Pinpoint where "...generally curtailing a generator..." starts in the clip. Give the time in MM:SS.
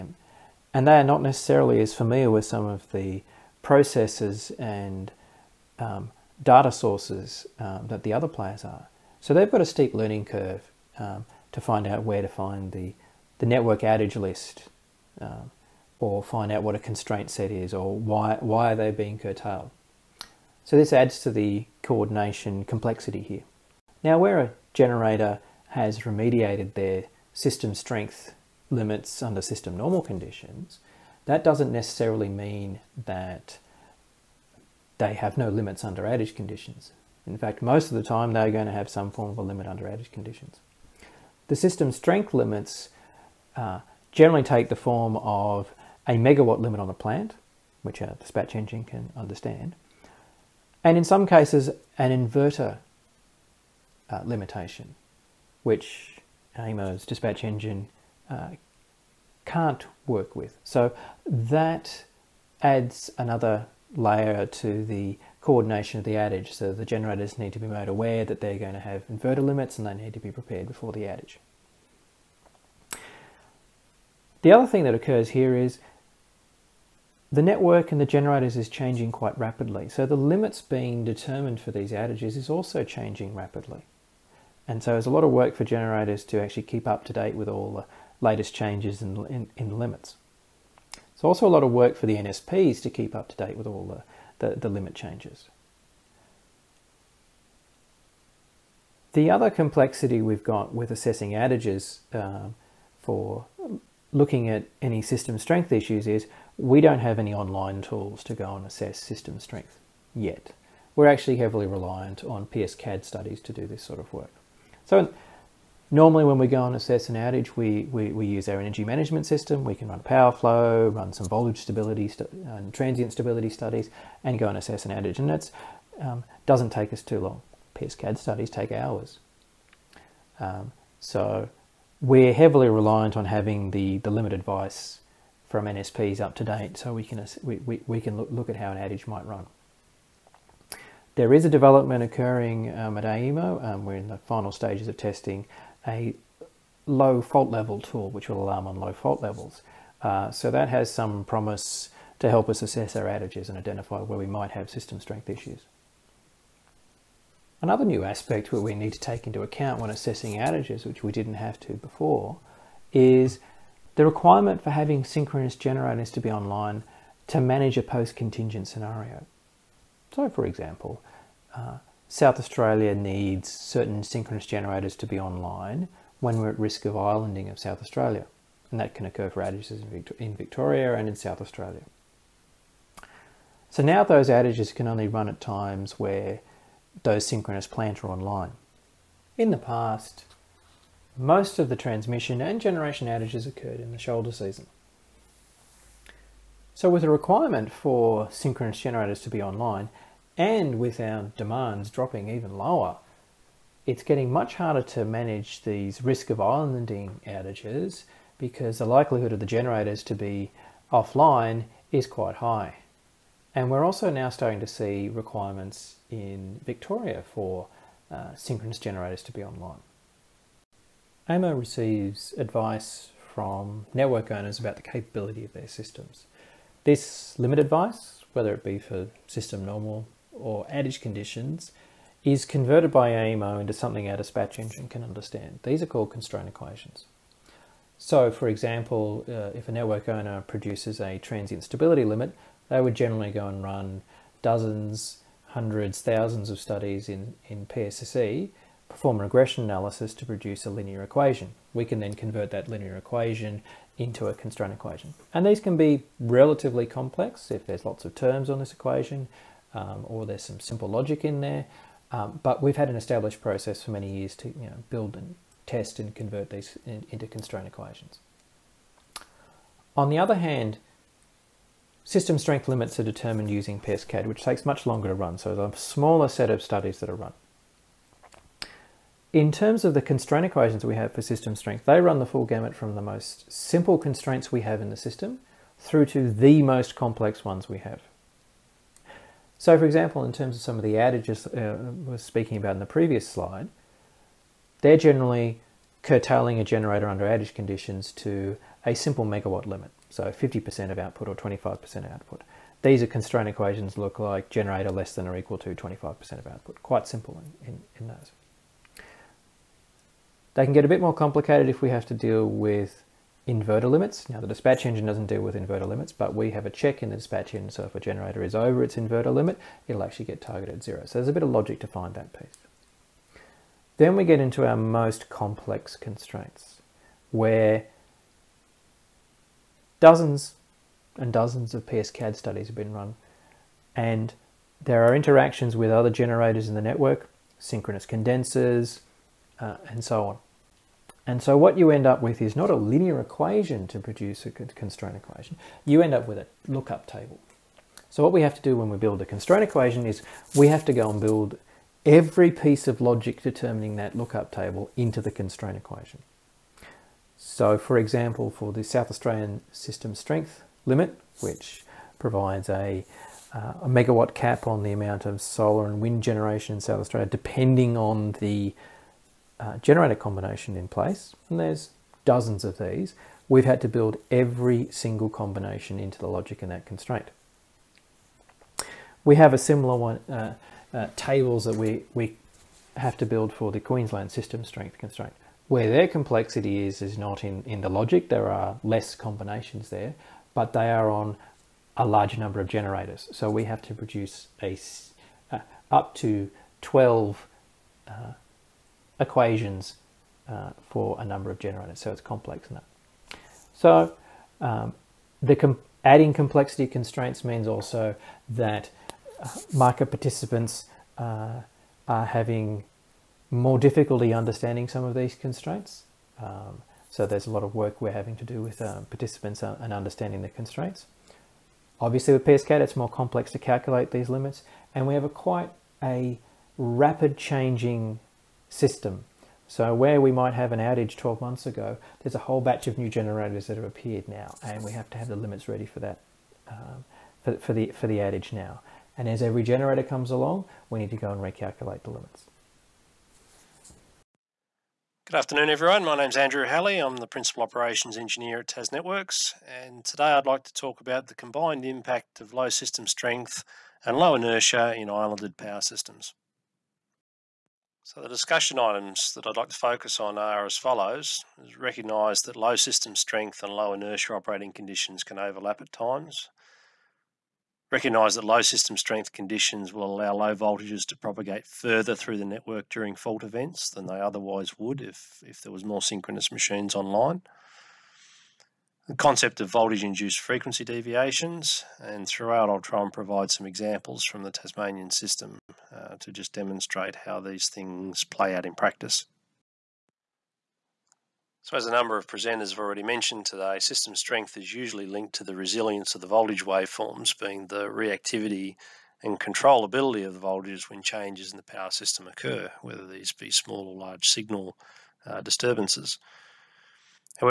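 04:54.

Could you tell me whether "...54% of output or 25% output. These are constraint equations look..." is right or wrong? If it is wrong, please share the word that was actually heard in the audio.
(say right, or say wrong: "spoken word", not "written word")
wrong: "50", not "54".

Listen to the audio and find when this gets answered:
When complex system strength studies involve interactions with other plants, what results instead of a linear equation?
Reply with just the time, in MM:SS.
05:46.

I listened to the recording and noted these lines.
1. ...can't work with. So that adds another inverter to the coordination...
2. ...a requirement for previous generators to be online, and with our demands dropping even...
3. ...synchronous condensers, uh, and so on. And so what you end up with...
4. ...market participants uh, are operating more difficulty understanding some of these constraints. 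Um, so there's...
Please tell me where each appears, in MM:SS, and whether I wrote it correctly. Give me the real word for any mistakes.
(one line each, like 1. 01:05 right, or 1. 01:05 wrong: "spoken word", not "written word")
1. 00:59 wrong: "layer", not "inverter"
2. 03:17 wrong: "synchronous", not "previous"
3. 05:37 right
4. 06:49 wrong: "having", not "operating".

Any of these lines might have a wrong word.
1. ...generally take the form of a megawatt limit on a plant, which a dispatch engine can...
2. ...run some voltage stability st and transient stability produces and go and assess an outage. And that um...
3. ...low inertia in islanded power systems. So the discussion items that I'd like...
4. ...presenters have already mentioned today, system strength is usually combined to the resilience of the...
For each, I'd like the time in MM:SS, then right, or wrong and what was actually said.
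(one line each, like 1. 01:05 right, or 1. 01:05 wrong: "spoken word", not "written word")
1. 00:44 right
2. 02:00 wrong: "studies", not "produces"
3. 07:34 right
4. 08:12 wrong: "linked", not "combined".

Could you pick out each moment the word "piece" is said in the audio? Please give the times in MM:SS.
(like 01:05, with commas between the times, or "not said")
05:22, 05:52.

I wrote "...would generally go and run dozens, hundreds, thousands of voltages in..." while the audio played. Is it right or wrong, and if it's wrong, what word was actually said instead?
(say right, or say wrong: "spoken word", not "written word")
wrong: "studies", not "voltages".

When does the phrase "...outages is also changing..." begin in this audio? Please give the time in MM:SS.
01:21.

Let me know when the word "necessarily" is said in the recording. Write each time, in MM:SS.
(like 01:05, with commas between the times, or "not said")
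00:01, 00:31.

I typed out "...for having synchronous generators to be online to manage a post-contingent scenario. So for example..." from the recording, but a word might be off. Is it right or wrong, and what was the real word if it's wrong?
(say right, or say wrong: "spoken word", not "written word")
right.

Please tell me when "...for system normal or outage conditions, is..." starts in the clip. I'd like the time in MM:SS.
03:48.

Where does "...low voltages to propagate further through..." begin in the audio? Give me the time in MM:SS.
07:50.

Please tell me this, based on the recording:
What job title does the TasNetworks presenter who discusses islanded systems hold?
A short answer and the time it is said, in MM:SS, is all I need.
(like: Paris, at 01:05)
Principal Operations Engineer, at 07:27.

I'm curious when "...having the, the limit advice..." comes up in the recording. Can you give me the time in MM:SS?
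02:13.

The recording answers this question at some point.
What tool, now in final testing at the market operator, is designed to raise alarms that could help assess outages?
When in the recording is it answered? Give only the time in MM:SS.
02:26.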